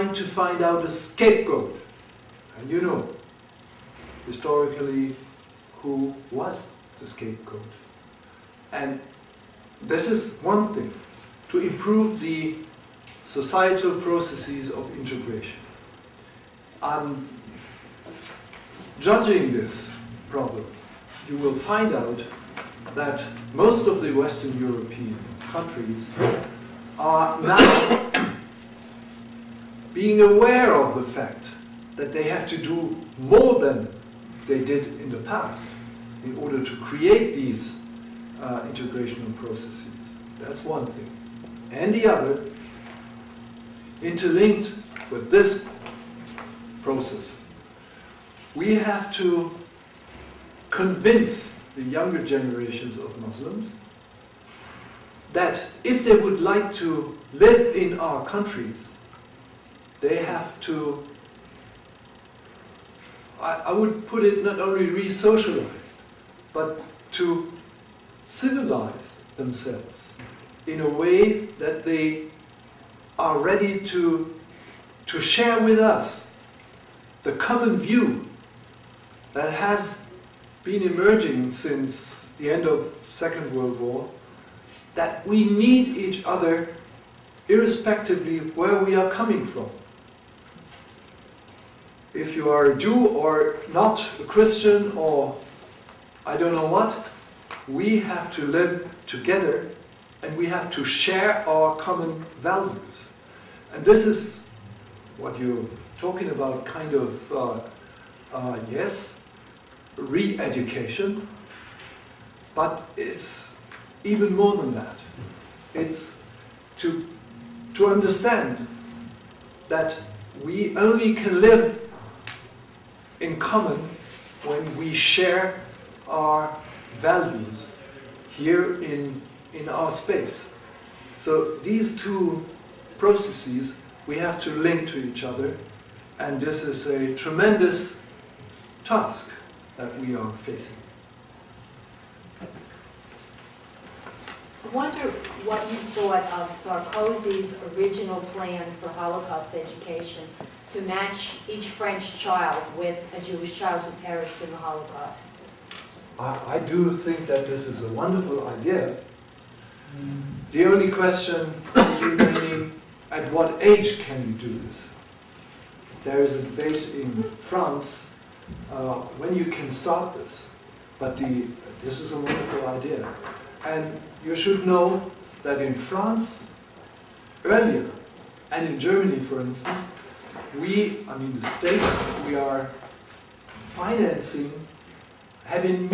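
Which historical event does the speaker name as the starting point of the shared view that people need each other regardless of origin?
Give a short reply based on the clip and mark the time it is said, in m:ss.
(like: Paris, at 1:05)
End of Second World War, at 1:22.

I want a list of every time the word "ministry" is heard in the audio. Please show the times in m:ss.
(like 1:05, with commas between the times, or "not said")
not said.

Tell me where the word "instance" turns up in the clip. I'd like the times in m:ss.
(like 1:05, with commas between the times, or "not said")
2:59.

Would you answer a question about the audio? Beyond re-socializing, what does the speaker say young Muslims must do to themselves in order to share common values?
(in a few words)
civilize themselves.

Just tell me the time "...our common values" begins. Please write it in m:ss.
1:41.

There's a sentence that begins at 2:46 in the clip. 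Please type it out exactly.
There is a debate in France uh, when you can start this, but the, this is a wonderful idea.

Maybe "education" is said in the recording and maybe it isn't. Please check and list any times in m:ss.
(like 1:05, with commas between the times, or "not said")
1:49, 2:29.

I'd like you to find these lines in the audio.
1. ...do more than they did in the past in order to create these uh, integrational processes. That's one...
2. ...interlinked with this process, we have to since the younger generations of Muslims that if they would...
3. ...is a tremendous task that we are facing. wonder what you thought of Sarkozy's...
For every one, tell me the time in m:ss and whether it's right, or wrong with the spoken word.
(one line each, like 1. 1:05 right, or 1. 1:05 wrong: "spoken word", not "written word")
1. 0:32 right
2. 0:44 wrong: "convince", not "since"
3. 2:16 right.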